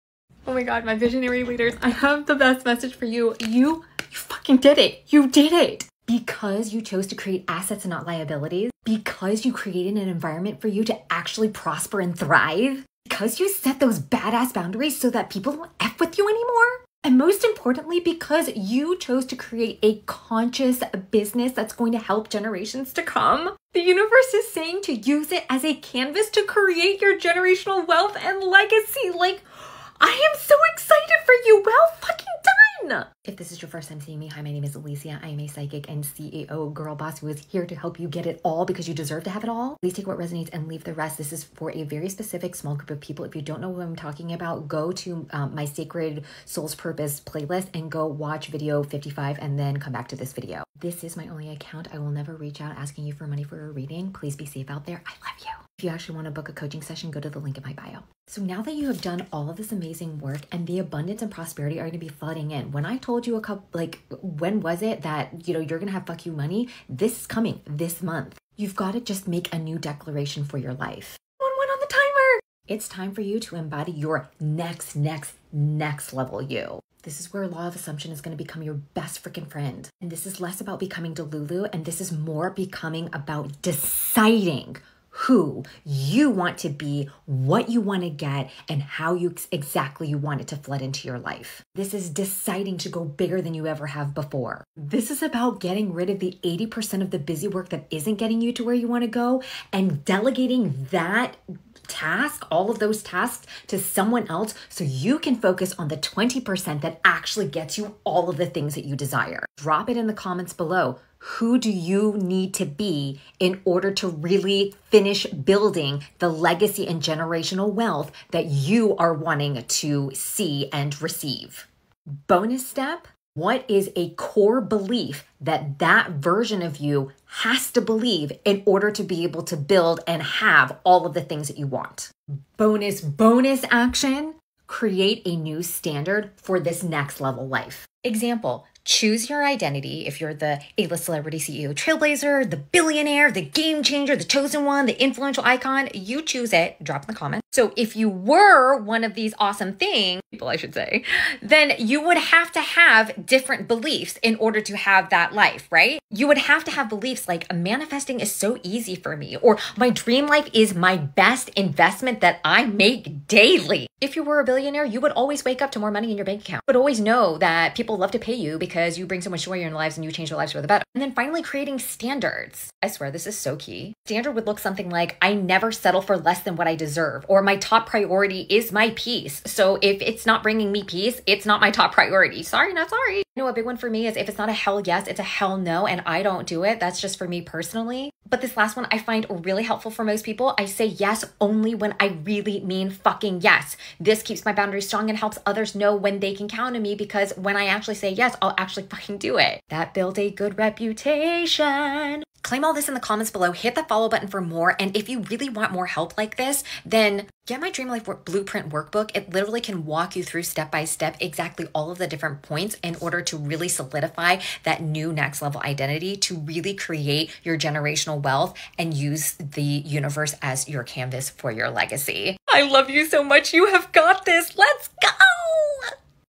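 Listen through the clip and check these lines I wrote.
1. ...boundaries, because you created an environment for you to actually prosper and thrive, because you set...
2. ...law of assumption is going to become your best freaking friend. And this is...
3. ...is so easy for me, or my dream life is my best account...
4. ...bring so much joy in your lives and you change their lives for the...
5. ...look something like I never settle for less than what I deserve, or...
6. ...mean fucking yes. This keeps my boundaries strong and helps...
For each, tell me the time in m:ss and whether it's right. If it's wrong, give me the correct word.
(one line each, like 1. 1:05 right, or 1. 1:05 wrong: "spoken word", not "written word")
1. 0:08 wrong: "liabilities", not "boundaries"
2. 1:17 right
3. 2:38 wrong: "investment", not "account"
4. 2:49 right
5. 2:54 right
6. 3:12 right.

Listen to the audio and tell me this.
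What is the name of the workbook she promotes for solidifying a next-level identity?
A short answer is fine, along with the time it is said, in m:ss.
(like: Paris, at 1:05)
Dream Life Blueprint, at 3:27.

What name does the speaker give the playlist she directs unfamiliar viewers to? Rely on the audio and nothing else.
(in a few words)
Sacred Soul's Purpose.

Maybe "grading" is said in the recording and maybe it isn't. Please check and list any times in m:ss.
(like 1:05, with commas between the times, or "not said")
not said.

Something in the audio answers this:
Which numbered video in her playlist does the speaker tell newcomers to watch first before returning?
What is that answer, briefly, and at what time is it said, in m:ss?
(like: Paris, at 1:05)
55, at 0:48.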